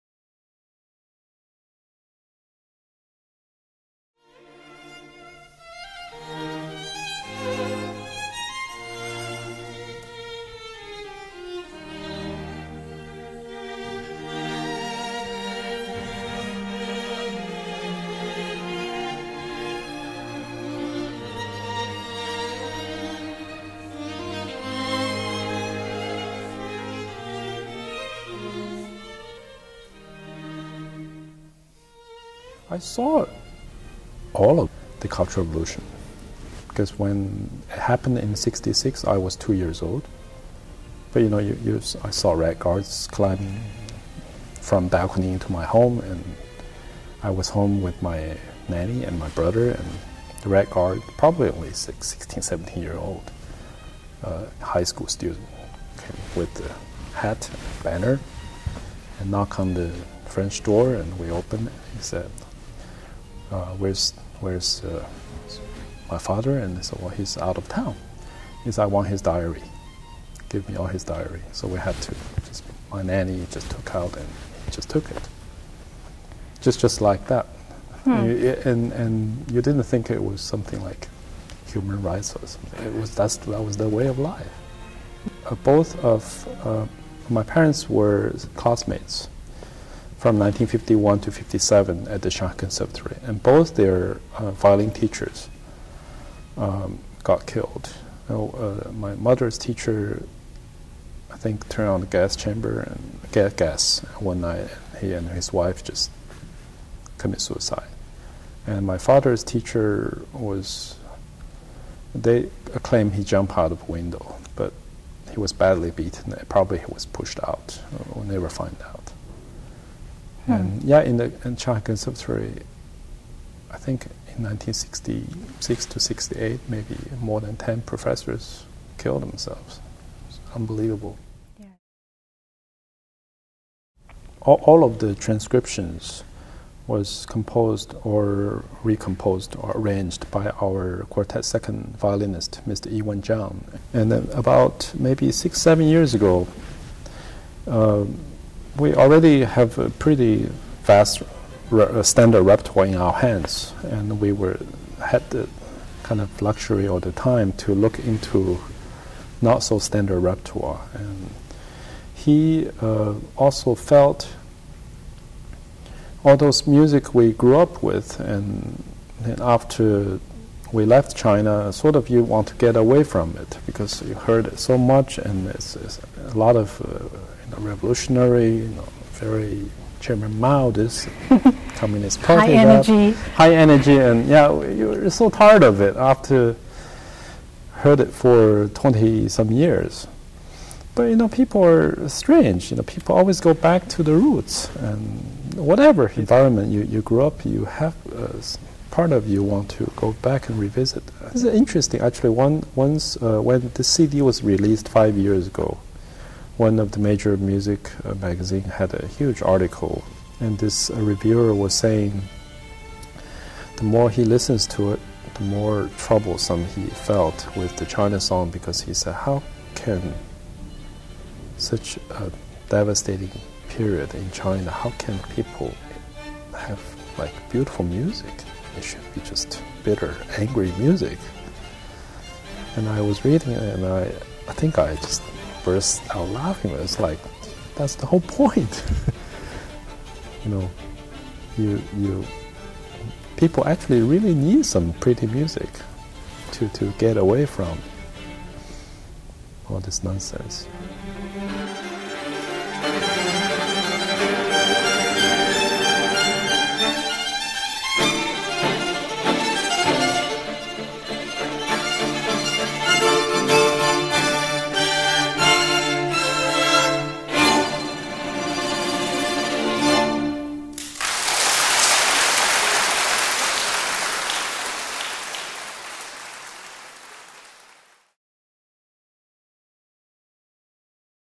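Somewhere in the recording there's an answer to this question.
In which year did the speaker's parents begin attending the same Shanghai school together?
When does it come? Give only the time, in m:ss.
1:30.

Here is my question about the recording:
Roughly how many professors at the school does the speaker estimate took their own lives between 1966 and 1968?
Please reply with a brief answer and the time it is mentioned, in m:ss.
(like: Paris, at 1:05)
More than 10, at 2:07.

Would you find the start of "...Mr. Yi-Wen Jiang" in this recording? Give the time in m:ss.
2:22.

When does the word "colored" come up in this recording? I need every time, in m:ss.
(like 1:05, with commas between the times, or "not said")
not said.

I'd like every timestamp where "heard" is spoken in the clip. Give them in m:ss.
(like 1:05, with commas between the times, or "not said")
2:54, 3:07.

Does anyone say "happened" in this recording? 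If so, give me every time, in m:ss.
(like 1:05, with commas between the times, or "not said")
0:37.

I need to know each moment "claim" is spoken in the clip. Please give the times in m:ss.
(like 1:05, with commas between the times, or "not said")
1:52.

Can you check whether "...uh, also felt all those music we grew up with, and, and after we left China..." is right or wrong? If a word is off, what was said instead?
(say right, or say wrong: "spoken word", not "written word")
right.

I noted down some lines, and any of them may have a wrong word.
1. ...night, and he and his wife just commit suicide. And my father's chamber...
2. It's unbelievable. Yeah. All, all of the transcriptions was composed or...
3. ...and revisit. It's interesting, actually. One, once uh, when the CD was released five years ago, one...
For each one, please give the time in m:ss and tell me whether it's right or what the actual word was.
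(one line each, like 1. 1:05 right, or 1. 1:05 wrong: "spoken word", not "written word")
1. 1:44 wrong: "teacher", not "chamber"
2. 2:10 right
3. 3:20 right.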